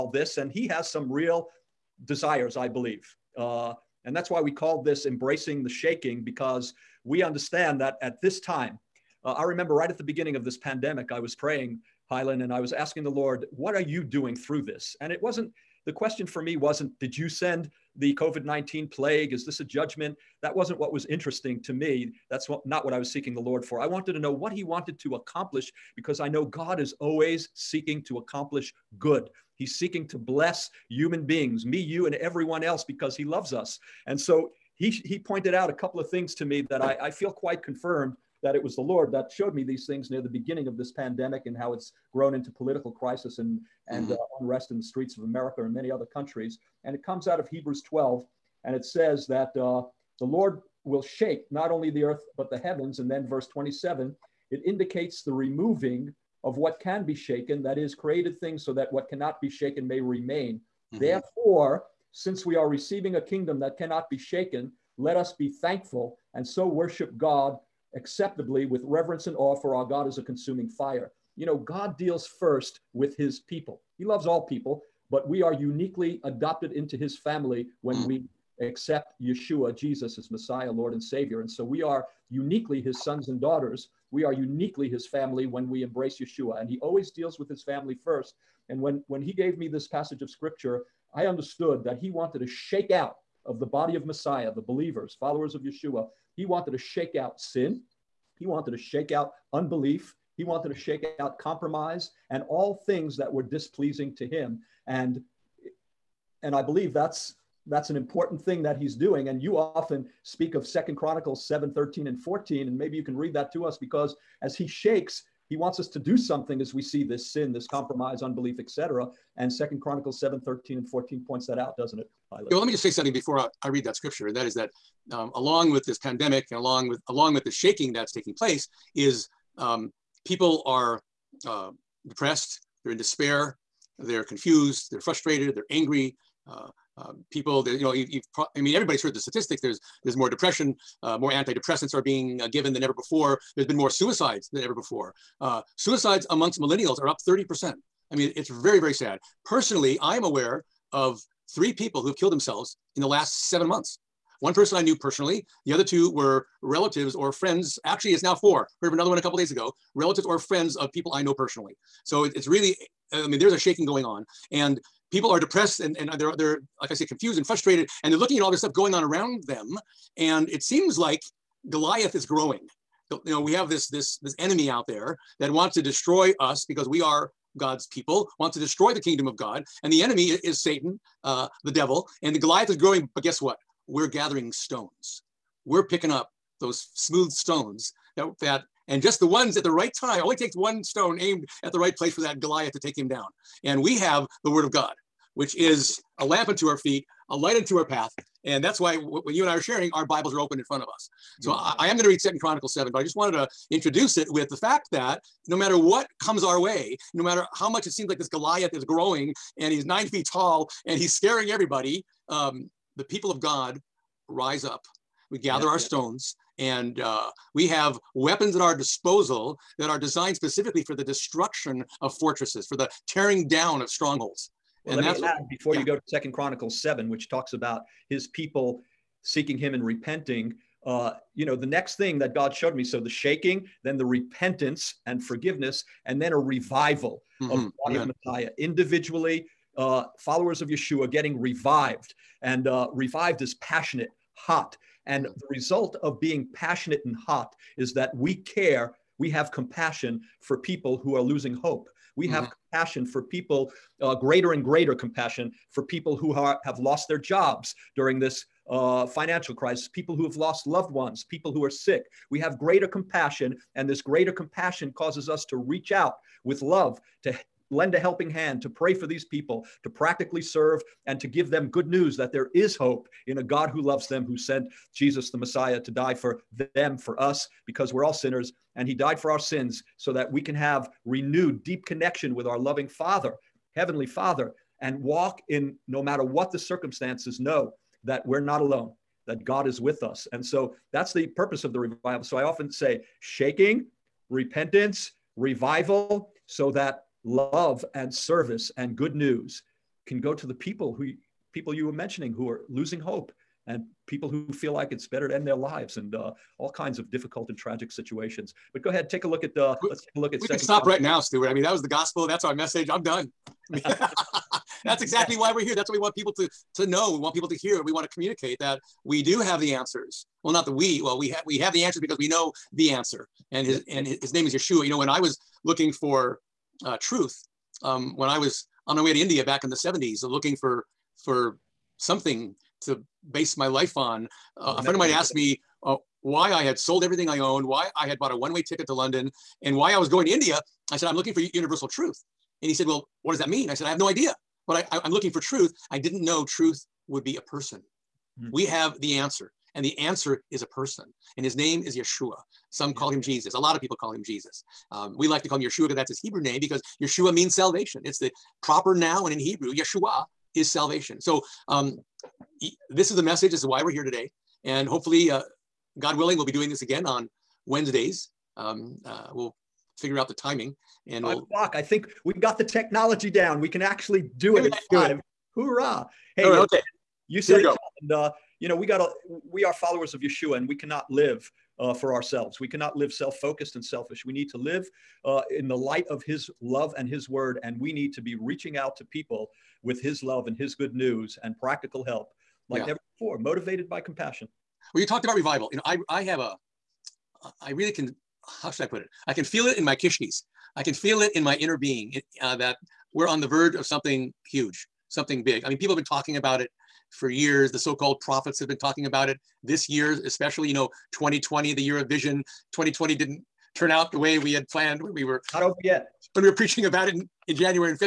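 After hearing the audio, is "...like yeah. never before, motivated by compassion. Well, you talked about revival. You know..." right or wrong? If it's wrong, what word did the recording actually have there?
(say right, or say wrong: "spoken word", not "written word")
right.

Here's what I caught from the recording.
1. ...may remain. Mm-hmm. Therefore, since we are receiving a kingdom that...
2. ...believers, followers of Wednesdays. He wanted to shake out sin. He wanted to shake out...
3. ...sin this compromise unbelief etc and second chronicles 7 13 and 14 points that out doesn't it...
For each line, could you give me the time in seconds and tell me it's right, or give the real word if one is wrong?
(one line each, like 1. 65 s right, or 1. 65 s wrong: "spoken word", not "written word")
1. 59 s right
2. 94 s wrong: "Yeshua", not "Wednesdays"
3. 117 s right.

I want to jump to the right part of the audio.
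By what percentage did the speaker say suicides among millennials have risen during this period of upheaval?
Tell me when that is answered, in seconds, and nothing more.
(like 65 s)
147 s.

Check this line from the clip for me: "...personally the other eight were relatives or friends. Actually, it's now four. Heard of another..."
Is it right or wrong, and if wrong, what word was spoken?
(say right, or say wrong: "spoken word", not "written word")
wrong: "two", not "eight".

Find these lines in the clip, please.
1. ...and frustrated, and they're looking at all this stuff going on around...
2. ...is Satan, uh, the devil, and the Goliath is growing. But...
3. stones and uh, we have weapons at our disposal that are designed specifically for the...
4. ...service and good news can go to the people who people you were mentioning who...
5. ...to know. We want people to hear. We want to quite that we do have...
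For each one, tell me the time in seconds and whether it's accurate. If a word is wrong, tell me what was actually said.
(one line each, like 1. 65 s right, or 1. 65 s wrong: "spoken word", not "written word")
1. 167 s right
2. 180 s right
3. 215 s right
4. 298 s right
5. 316 s wrong: "communicate", not "quite".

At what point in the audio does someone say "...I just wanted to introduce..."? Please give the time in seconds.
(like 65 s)
202 s.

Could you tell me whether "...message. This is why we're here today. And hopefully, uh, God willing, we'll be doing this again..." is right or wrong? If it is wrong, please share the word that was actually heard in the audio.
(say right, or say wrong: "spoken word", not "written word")
right.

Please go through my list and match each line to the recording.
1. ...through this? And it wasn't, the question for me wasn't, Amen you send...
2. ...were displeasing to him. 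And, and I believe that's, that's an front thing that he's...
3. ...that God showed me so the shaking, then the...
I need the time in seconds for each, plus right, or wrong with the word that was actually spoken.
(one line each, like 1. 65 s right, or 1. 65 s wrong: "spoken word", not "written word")
1. 14 s wrong: "Did", not "Amen"
2. 103 s wrong: "important", not "front"
3. 232 s right.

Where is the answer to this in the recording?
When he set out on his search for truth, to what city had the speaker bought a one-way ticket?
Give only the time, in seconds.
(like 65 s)
338 s.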